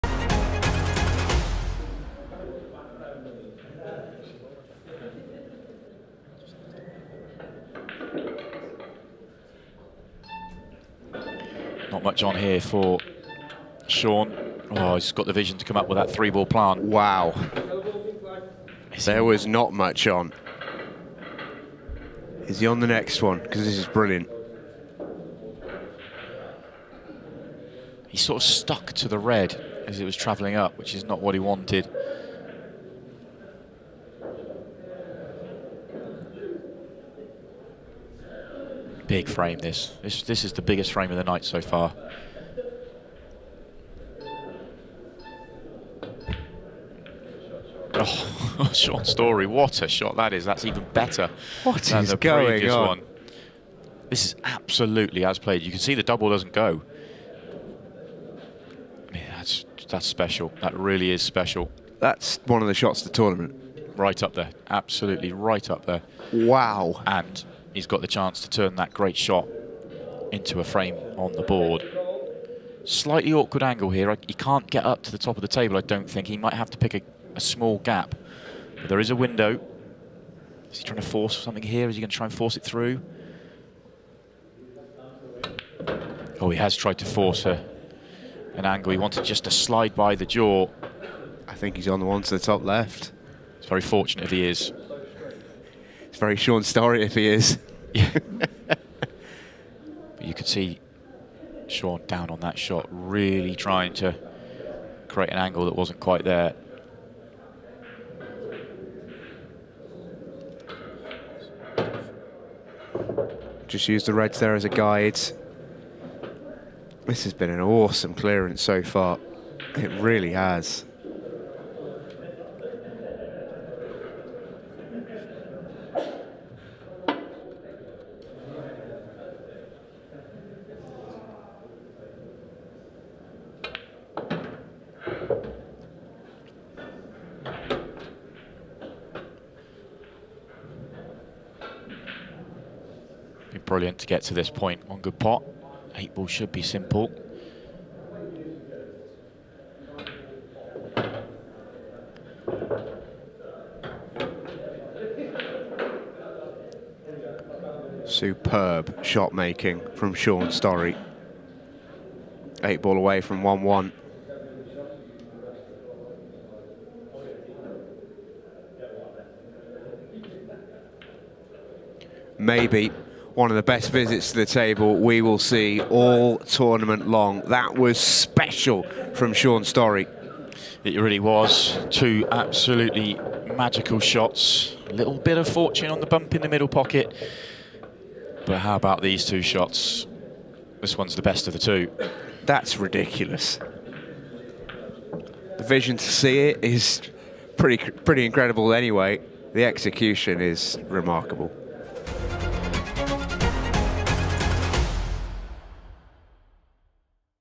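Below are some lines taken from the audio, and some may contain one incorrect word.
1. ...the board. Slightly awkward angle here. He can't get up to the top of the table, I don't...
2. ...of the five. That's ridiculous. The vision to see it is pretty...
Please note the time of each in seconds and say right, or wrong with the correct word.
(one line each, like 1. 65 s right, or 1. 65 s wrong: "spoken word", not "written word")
1. 71 s right
2. 191 s wrong: "two", not "five".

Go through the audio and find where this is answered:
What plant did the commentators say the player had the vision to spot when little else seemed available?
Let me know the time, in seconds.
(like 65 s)
16 s.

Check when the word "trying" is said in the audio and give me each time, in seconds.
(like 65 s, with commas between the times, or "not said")
80 s, 103 s.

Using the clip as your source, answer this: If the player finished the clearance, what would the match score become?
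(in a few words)
1-1.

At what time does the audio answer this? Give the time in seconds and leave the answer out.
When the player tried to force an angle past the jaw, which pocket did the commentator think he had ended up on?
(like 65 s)
92 s.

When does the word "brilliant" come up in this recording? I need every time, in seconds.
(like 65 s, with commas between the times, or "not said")
23 s, 143 s.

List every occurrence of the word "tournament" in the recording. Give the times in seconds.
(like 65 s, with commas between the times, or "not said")
63 s, 176 s.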